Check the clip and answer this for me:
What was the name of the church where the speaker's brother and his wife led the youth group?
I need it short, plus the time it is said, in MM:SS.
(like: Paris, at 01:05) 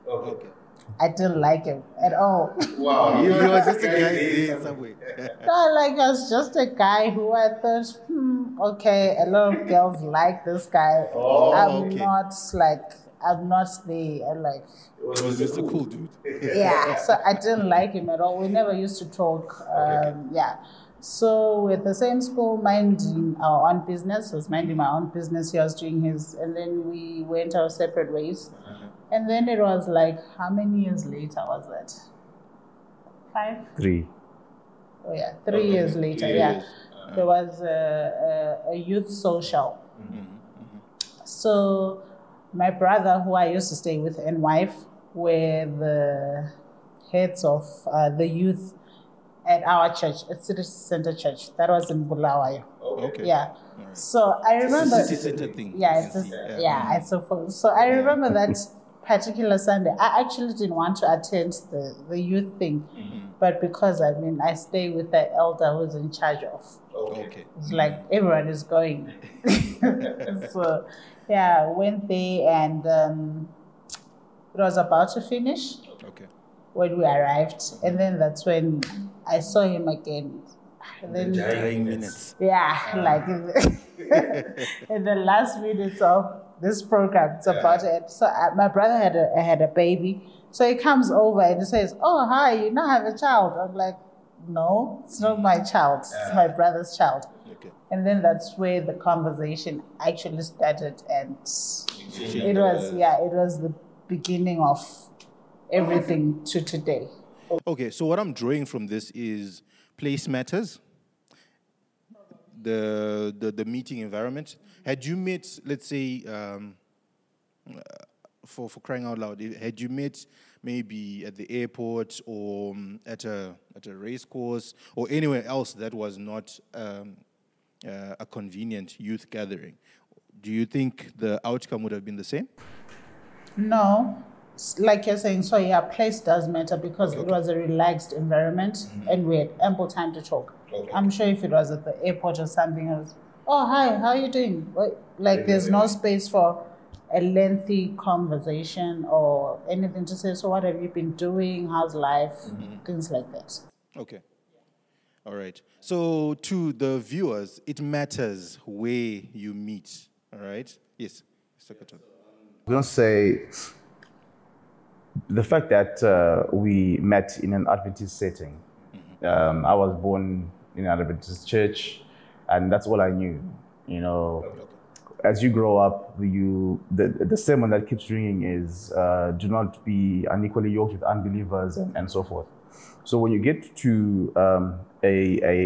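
City Center Church, at 00:50.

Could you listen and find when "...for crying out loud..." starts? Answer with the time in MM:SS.
01:58.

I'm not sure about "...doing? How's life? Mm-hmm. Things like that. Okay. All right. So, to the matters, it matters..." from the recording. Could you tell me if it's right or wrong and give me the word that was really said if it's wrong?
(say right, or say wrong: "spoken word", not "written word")
wrong: "viewers", not "matters".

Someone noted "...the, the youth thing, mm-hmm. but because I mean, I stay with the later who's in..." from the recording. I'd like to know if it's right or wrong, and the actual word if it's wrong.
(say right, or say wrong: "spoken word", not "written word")
wrong: "elder", not "later".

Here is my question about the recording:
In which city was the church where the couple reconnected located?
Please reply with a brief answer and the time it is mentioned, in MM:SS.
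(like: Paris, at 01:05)
Bulawayo, at 00:52.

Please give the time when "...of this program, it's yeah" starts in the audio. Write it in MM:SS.
01:26.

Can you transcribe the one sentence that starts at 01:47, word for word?
Okay, so what I'm drawing from this is place matters, the the, the meeting environment.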